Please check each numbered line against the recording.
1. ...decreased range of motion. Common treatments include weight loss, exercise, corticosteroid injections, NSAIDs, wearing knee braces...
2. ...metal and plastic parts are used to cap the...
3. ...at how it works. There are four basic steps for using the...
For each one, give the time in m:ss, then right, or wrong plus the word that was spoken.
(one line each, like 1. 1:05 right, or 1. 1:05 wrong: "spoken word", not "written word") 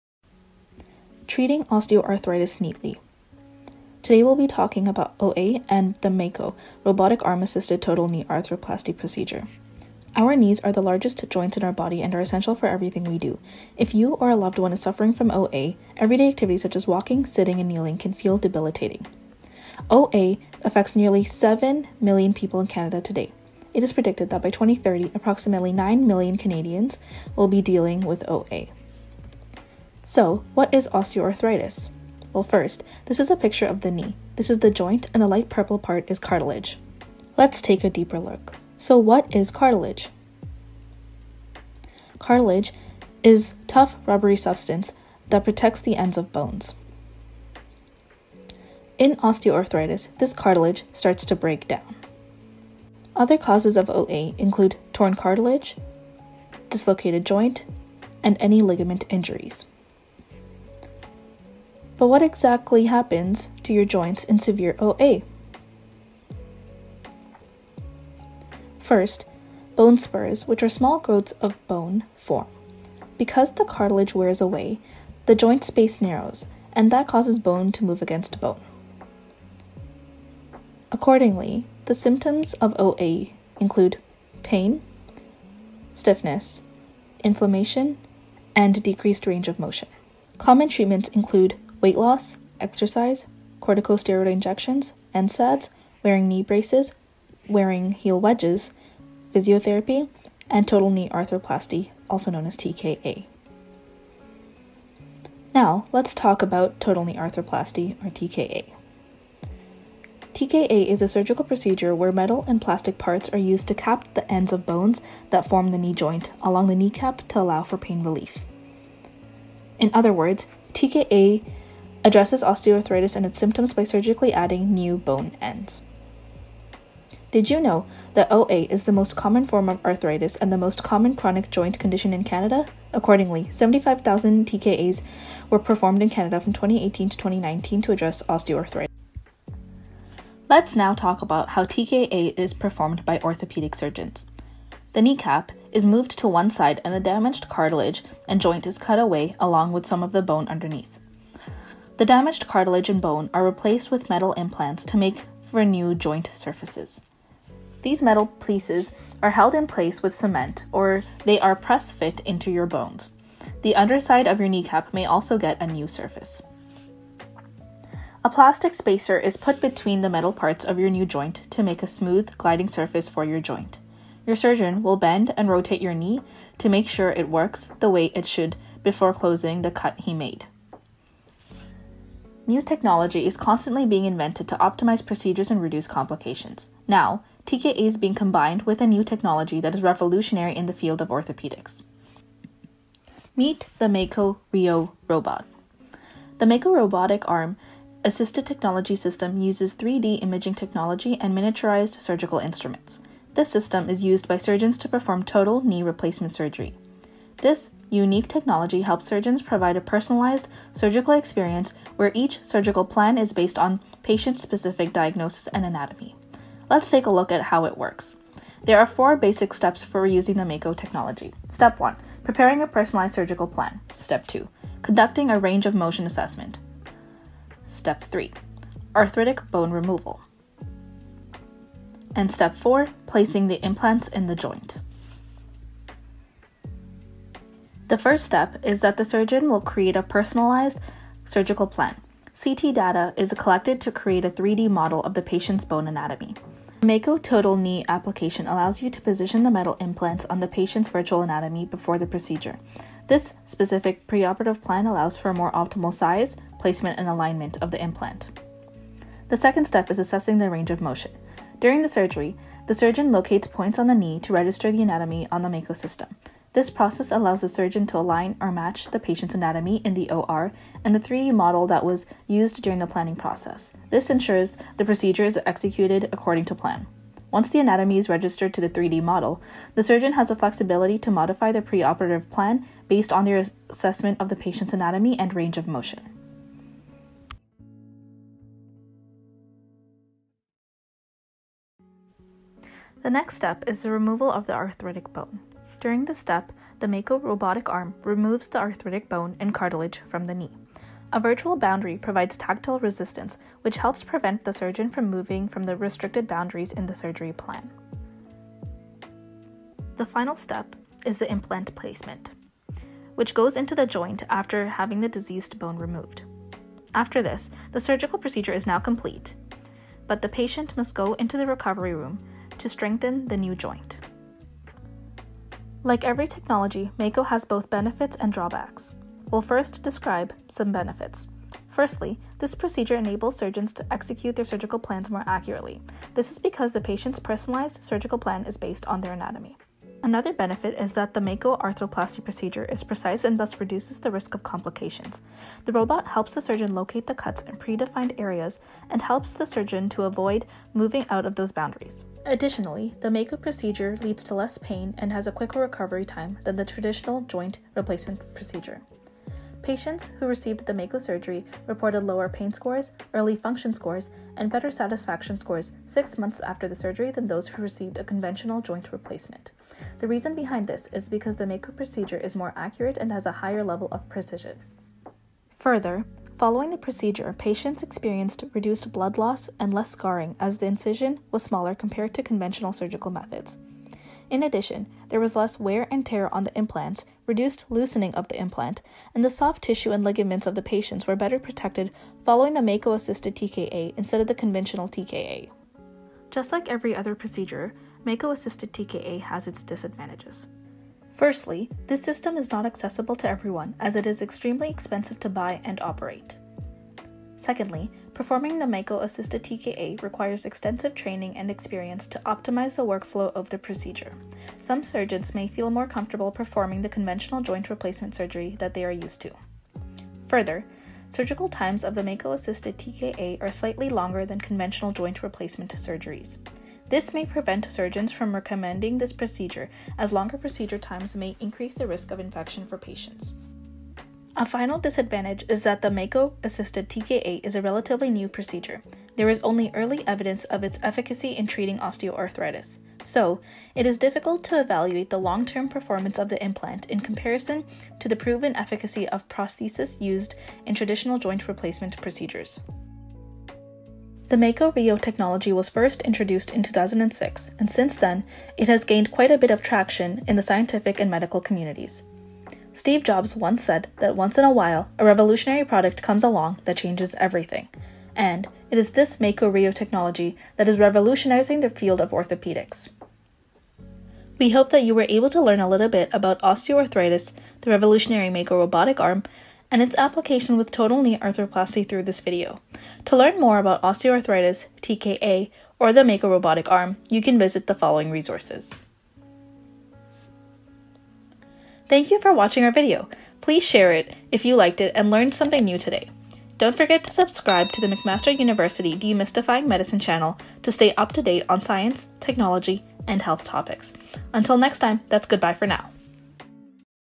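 1. 1:28 right
2. 1:52 right
3. 3:37 right.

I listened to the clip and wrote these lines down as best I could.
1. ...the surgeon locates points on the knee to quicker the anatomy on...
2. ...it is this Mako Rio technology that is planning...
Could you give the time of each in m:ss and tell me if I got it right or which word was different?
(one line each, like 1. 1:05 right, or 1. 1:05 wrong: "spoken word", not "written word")
1. 4:22 wrong: "register", not "quicker"
2. 7:48 wrong: "revolutionizing", not "planning".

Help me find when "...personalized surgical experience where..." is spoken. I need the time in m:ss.
3:29.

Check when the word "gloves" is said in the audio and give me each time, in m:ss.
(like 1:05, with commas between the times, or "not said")
not said.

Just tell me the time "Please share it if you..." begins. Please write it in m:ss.
8:13.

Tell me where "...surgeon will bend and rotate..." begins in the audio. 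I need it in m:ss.
2:54.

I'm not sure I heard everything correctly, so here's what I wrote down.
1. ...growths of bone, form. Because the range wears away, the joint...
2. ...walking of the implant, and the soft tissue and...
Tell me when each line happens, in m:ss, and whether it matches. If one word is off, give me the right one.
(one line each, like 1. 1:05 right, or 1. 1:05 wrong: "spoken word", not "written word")
1. 1:10 wrong: "cartilage", not "range"
2. 6:27 wrong: "loosening", not "walking".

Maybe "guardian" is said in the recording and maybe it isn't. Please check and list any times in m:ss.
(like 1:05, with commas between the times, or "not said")
not said.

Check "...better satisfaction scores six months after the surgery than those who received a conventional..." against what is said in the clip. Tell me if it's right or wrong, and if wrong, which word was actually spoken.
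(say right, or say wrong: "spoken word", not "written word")
right.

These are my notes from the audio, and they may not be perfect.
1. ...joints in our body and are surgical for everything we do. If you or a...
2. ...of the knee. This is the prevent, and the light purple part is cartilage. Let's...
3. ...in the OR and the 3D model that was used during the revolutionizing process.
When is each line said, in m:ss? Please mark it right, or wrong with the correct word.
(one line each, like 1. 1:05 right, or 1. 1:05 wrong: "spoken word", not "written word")
1. 0:11 wrong: "essential", not "surgical"
2. 0:33 wrong: "joint", not "prevent"
3. 4:29 wrong: "planning", not "revolutionizing".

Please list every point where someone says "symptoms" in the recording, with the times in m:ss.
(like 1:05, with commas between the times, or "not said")
1:21, 2:03.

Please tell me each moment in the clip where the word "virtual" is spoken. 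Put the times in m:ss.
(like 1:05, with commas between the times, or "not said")
4:10, 5:01.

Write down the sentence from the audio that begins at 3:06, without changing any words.
Now, TKA is being combined with a new technology that is revolutionary in the field of orthopedics.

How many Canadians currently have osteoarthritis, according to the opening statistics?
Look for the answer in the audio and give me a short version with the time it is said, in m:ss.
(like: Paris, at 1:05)
7 million, at 0:20.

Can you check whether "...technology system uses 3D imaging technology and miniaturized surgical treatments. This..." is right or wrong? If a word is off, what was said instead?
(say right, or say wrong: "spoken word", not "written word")
wrong: "instruments", not "treatments".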